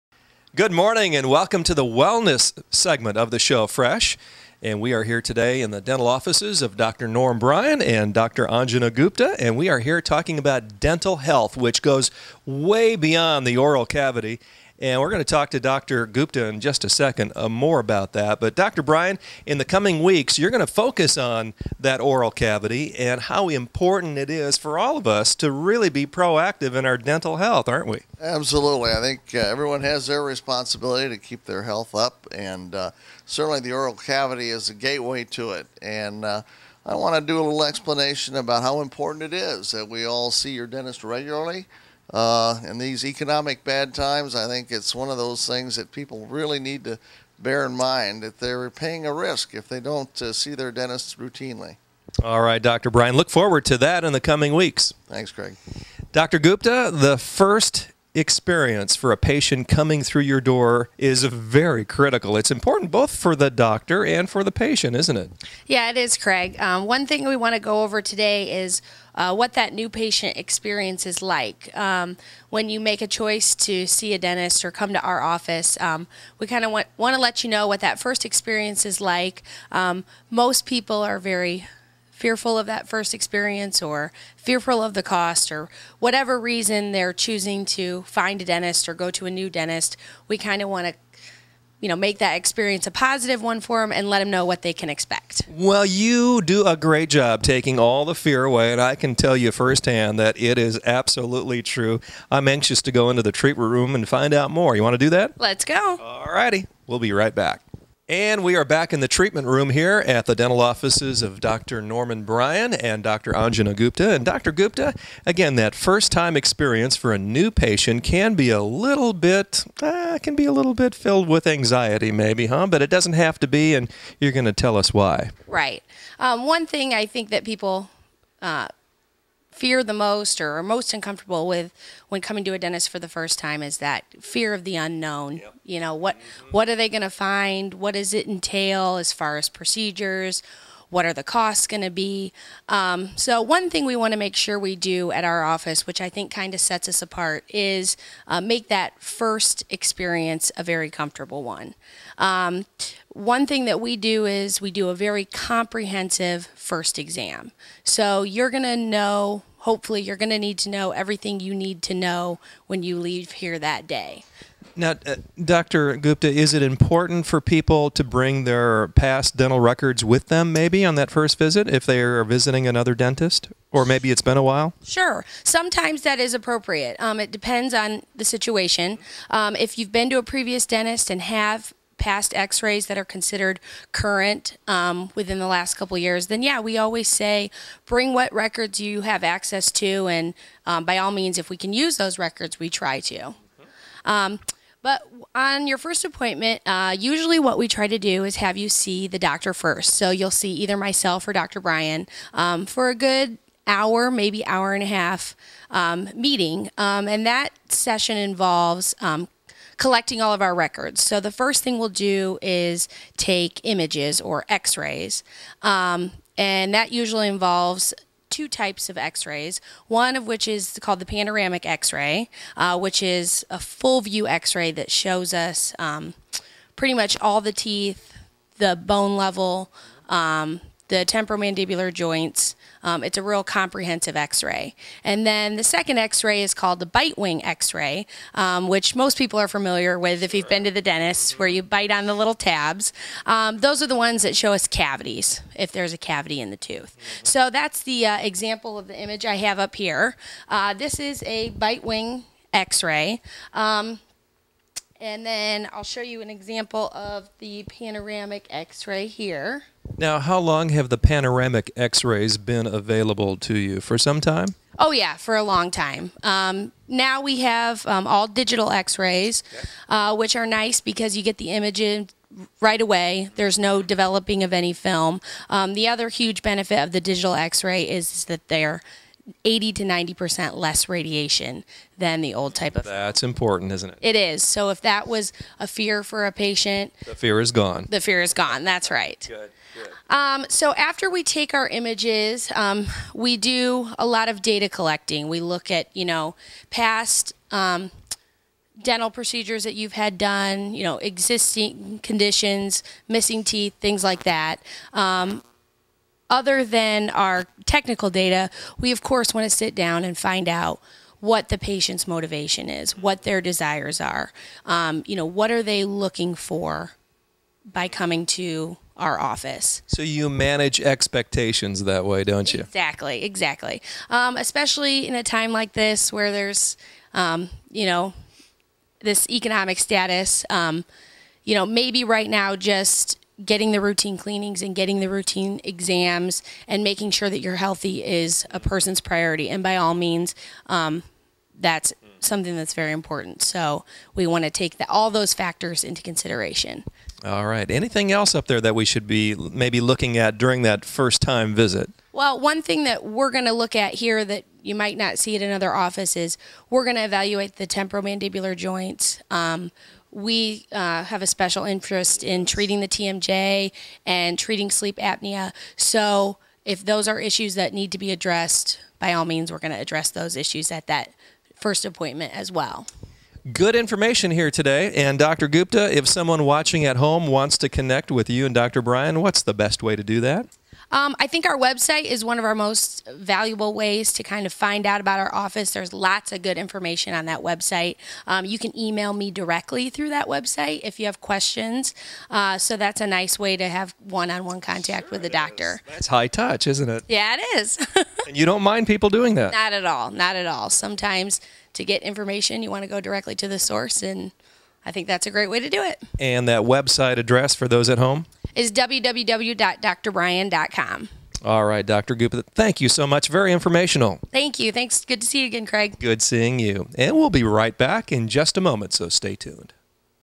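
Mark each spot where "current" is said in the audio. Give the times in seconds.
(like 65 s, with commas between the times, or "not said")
183 s.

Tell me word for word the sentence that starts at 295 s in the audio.
We look at you know past um, dental procedures that you've had done, you know, existing conditions, missing teeth, things like that.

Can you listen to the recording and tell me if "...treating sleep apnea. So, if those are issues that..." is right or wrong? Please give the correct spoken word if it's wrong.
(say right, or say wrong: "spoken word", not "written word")
right.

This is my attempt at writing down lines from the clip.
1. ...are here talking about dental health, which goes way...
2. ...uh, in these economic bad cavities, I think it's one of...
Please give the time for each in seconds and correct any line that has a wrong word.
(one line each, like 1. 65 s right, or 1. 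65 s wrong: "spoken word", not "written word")
1. 9 s right
2. 42 s wrong: "times", not "cavities".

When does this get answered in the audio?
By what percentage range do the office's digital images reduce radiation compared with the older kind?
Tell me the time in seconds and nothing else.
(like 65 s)
279 s.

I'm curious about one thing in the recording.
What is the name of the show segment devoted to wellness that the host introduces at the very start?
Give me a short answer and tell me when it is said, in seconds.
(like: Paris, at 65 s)
Fresh, at 3 s.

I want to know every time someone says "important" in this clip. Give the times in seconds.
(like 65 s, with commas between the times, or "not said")
23 s, 38 s, 62 s, 166 s, 283 s, 342 s.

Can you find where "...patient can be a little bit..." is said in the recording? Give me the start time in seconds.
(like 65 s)
117 s.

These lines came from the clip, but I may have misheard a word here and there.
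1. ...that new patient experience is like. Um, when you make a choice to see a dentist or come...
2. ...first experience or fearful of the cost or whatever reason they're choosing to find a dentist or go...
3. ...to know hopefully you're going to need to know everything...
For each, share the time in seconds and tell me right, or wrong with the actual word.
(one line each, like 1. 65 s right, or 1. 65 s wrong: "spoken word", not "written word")
1. 69 s right
2. 82 s right
3. 158 s right.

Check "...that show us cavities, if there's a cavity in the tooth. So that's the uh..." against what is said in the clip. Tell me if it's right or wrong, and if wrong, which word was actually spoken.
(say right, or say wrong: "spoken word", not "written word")
right.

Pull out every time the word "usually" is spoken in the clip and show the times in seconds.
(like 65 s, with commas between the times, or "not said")
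196 s, 216 s.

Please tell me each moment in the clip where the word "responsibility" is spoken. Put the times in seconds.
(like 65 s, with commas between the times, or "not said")
30 s.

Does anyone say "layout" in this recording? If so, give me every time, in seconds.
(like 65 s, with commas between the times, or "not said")
not said.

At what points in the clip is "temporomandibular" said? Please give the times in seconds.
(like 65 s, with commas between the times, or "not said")
230 s, 357 s.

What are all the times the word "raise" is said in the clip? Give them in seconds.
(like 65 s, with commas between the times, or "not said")
not said.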